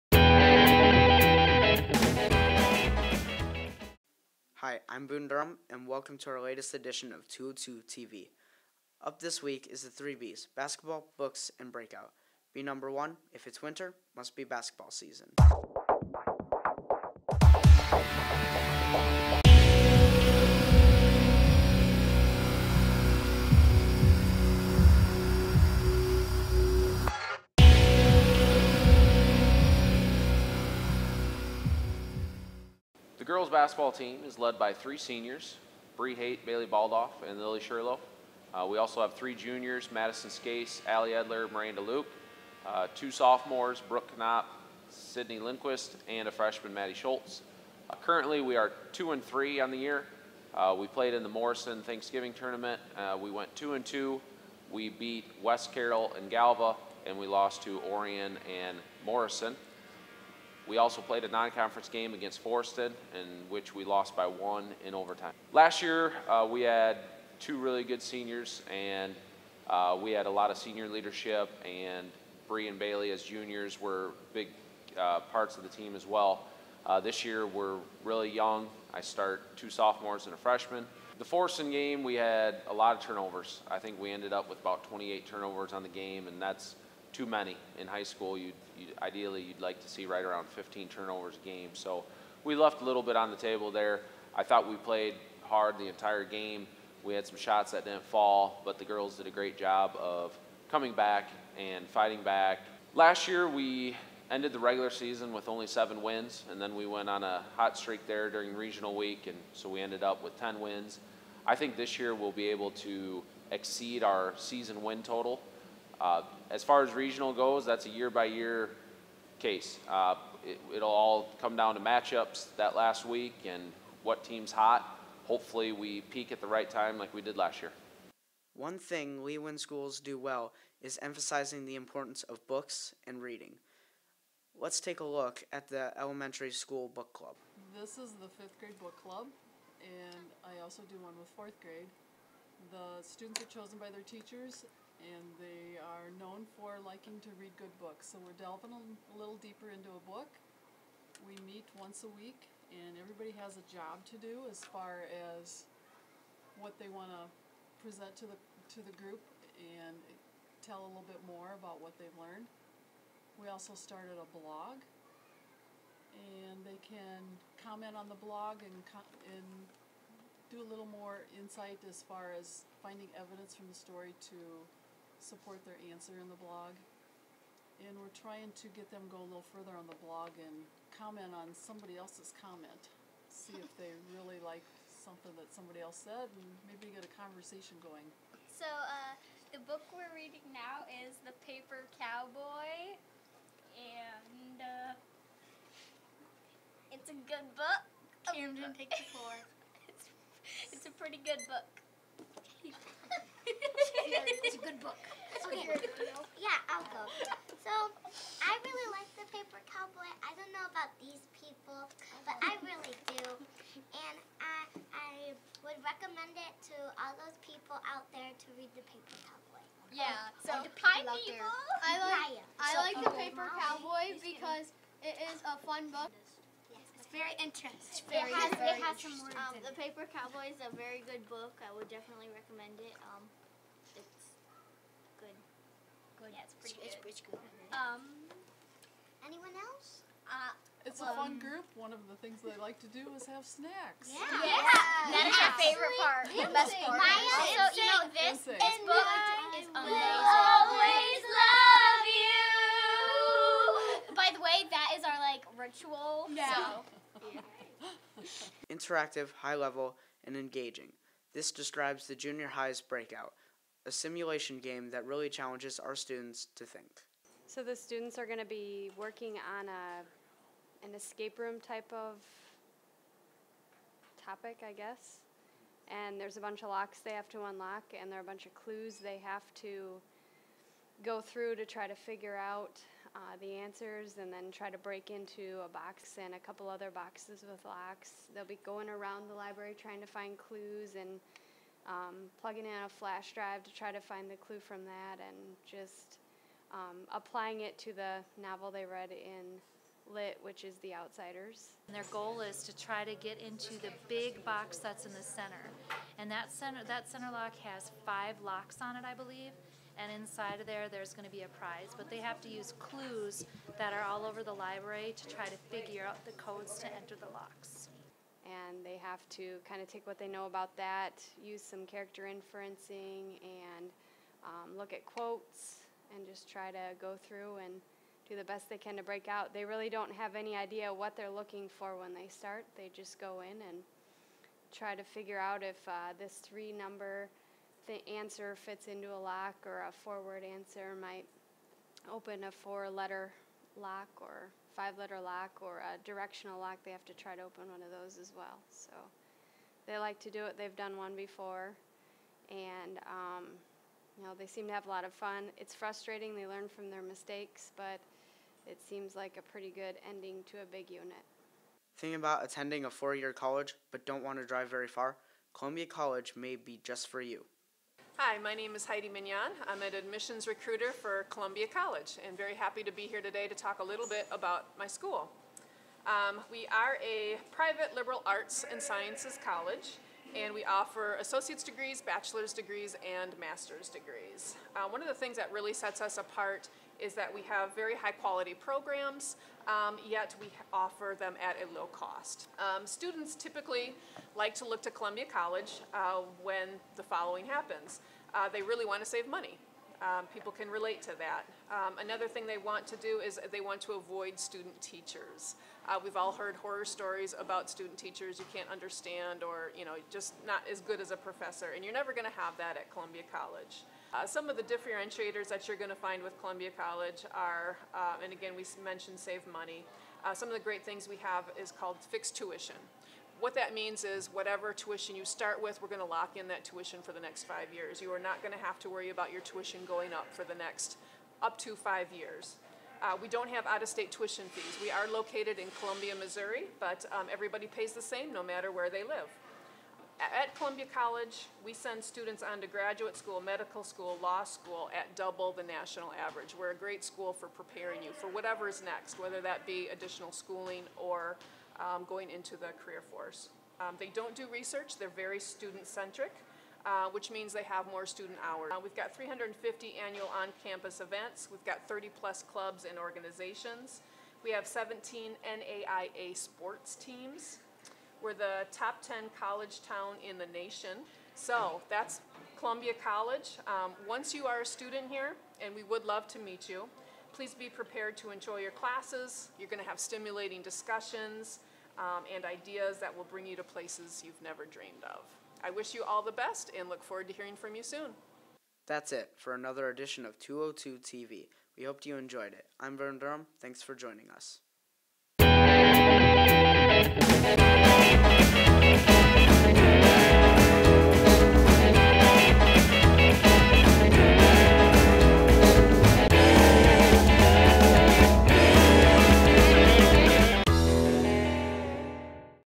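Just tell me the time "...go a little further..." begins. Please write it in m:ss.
2:59.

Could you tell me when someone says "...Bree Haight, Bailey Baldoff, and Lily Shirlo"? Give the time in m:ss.
0:35.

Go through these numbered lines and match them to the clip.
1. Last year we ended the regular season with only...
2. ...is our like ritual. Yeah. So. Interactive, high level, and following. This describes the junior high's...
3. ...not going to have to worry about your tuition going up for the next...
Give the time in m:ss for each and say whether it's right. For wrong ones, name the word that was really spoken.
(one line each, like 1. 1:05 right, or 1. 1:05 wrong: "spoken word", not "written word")
1. 1:42 right
2. 4:14 wrong: "engaging", not "following"
3. 7:08 right.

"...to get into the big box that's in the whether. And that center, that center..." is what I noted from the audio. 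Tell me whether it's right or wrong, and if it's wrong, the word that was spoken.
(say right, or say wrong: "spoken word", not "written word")
wrong: "center", not "whether".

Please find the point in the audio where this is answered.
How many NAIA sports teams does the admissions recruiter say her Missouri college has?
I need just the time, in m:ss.
7:44.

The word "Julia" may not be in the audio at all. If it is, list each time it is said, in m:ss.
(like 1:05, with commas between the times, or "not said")
not said.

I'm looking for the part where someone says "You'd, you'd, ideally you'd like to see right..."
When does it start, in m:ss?
1:28.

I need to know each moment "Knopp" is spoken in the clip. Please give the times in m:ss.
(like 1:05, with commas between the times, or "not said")
0:44.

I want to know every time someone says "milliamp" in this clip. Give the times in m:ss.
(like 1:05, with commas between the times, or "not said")
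not said.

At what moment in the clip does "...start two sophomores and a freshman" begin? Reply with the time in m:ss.
1:19.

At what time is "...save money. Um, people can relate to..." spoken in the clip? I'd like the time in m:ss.
6:39.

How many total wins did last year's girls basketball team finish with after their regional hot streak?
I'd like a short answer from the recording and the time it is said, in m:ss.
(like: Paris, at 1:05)
10, at 1:49.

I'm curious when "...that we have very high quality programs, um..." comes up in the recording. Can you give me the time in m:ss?
6:27.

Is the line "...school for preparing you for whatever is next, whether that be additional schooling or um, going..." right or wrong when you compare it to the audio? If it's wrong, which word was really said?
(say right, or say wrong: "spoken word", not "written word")
right.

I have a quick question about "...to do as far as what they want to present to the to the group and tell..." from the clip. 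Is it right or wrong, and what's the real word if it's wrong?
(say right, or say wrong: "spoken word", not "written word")
right.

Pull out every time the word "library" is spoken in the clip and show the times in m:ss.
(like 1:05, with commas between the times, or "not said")
4:49, 5:14.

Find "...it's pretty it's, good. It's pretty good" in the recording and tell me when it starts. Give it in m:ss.
3:56.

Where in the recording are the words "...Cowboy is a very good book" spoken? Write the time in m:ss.
3:50.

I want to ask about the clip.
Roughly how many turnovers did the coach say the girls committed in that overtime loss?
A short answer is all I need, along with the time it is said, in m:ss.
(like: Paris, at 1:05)
28, at 1:24.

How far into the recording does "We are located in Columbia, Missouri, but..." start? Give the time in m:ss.
7:14.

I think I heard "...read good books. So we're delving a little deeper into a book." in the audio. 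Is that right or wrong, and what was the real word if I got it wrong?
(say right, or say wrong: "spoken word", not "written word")
right.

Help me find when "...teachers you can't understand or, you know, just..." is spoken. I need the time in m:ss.
6:47.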